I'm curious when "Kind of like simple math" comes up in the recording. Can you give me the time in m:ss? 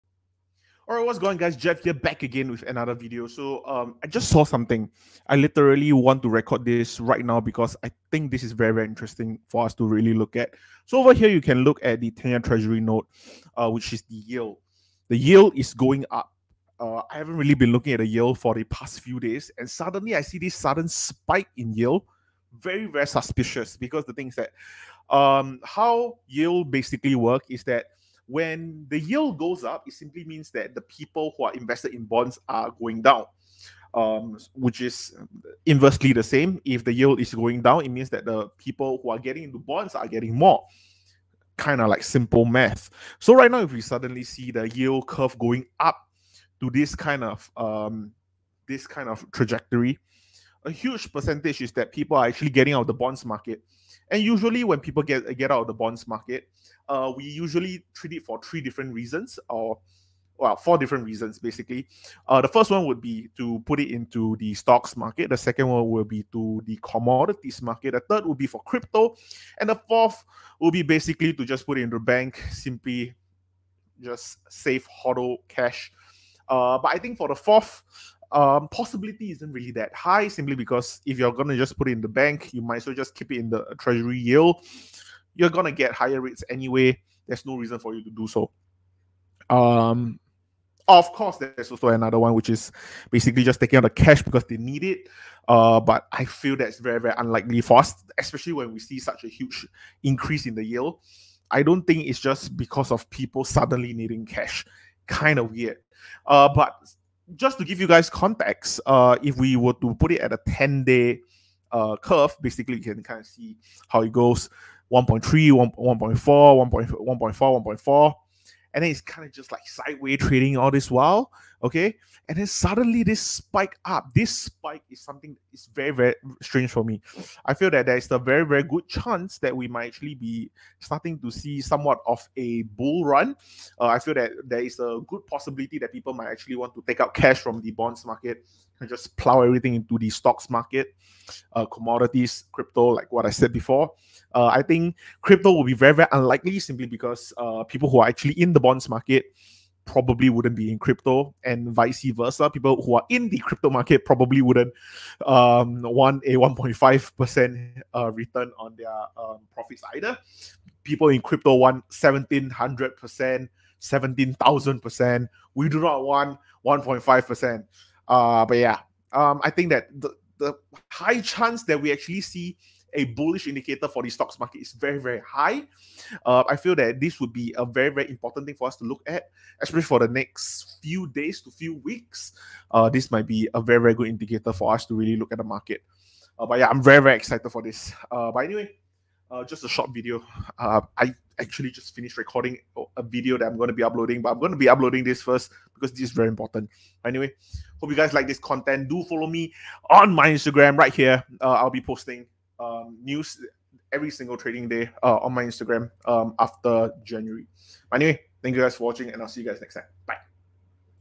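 0:41.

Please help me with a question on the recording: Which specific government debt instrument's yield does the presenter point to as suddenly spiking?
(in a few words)
10 year treasury note.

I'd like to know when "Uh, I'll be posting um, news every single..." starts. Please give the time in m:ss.
3:21.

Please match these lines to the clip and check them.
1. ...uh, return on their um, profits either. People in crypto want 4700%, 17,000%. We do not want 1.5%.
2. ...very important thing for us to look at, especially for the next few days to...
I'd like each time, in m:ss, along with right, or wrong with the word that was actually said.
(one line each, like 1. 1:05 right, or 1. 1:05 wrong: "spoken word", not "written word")
1. 2:37 wrong: "1700", not "4700"
2. 2:57 right.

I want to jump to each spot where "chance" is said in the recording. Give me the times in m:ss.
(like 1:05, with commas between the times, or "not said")
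2:08, 2:51.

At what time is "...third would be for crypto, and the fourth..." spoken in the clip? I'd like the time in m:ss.
1:08.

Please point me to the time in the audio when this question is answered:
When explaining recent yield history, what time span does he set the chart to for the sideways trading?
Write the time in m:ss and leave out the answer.
1:50.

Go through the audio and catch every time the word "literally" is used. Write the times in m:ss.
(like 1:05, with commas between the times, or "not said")
0:05.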